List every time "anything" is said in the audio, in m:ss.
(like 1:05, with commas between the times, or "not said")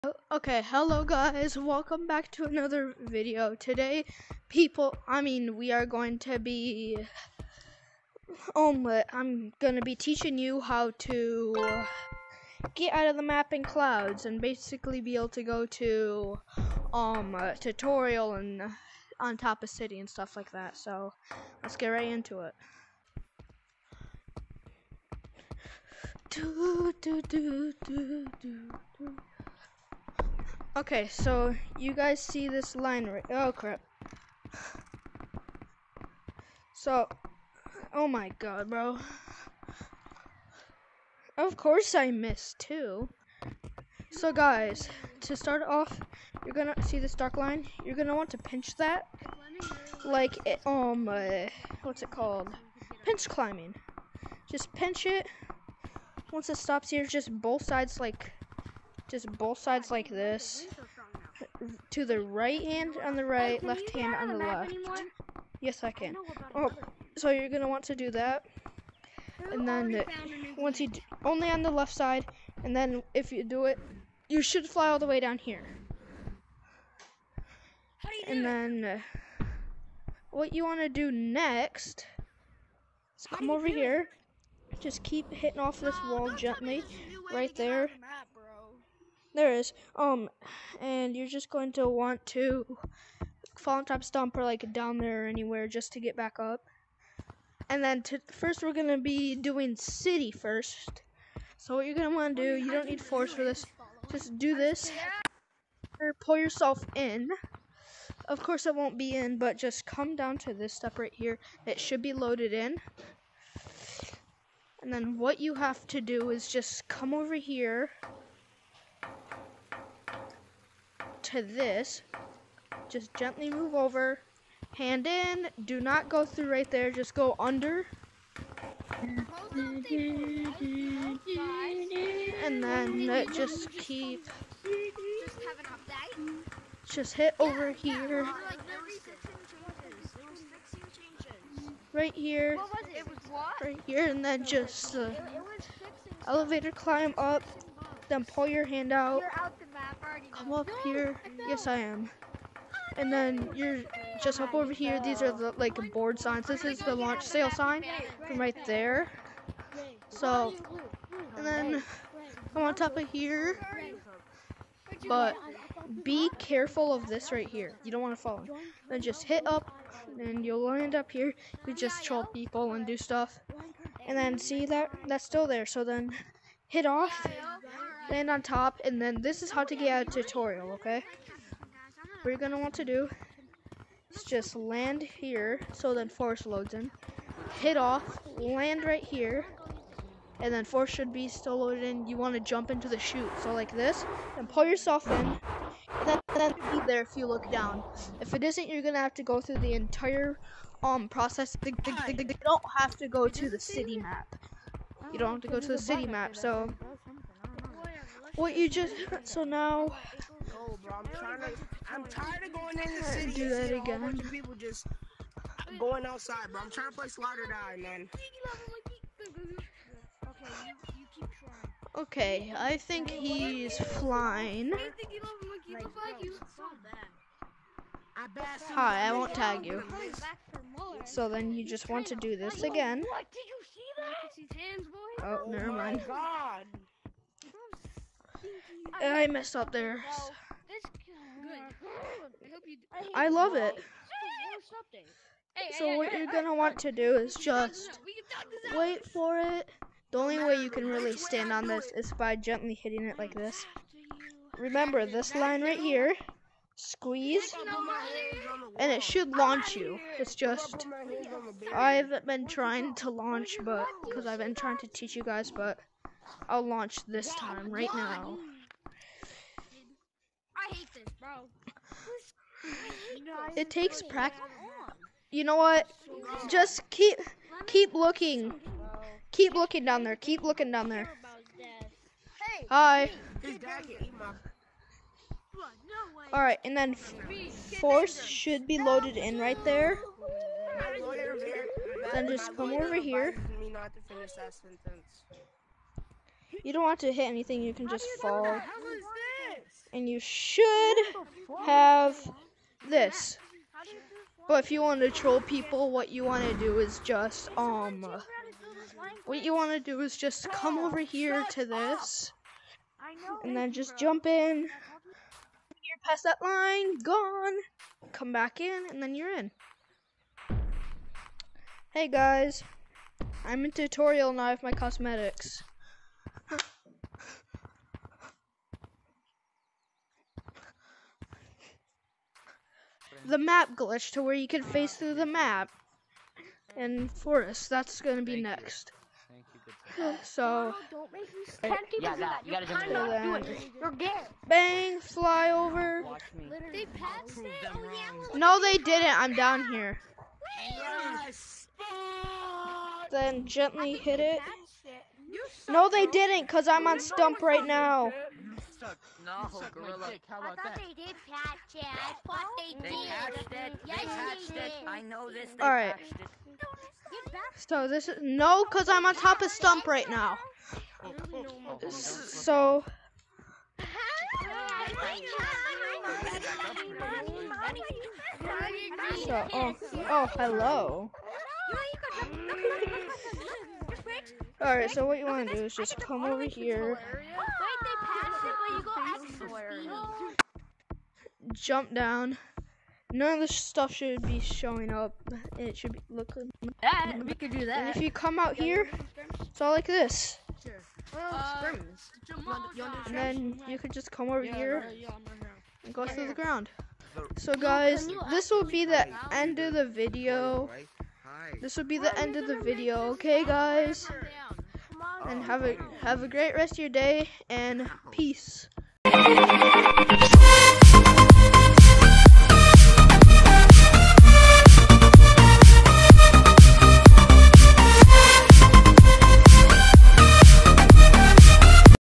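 4:57.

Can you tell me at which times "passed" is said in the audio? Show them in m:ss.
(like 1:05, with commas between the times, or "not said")
not said.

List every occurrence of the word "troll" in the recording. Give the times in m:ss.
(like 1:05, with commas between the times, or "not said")
2:52, 5:05.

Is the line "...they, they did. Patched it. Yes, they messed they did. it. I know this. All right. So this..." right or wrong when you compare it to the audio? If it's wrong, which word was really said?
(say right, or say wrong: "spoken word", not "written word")
wrong: "patched", not "messed".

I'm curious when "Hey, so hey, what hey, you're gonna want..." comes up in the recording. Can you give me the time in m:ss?
4:05.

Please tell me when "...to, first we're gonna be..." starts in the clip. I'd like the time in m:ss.
1:38.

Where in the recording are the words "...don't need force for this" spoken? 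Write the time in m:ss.
1:42.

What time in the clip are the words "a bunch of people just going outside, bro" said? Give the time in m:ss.
3:34.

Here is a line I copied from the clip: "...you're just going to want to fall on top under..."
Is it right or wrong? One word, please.
wrong.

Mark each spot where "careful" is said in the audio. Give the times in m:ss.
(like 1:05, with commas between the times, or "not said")
2:46.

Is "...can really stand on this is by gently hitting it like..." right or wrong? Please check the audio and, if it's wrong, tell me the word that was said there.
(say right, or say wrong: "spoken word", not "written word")
right.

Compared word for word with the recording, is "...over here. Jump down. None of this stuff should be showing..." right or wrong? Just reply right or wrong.
right.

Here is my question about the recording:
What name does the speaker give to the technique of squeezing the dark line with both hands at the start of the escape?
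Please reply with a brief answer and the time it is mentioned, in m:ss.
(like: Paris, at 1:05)
Pinch climbing, at 0:53.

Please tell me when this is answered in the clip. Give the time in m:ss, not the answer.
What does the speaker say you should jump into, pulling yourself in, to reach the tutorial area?
3:12.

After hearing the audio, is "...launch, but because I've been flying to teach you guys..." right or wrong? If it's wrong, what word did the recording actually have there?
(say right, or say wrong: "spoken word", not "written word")
wrong: "trying", not "flying".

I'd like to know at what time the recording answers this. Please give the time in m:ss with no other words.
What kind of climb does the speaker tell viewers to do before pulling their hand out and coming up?
2:26.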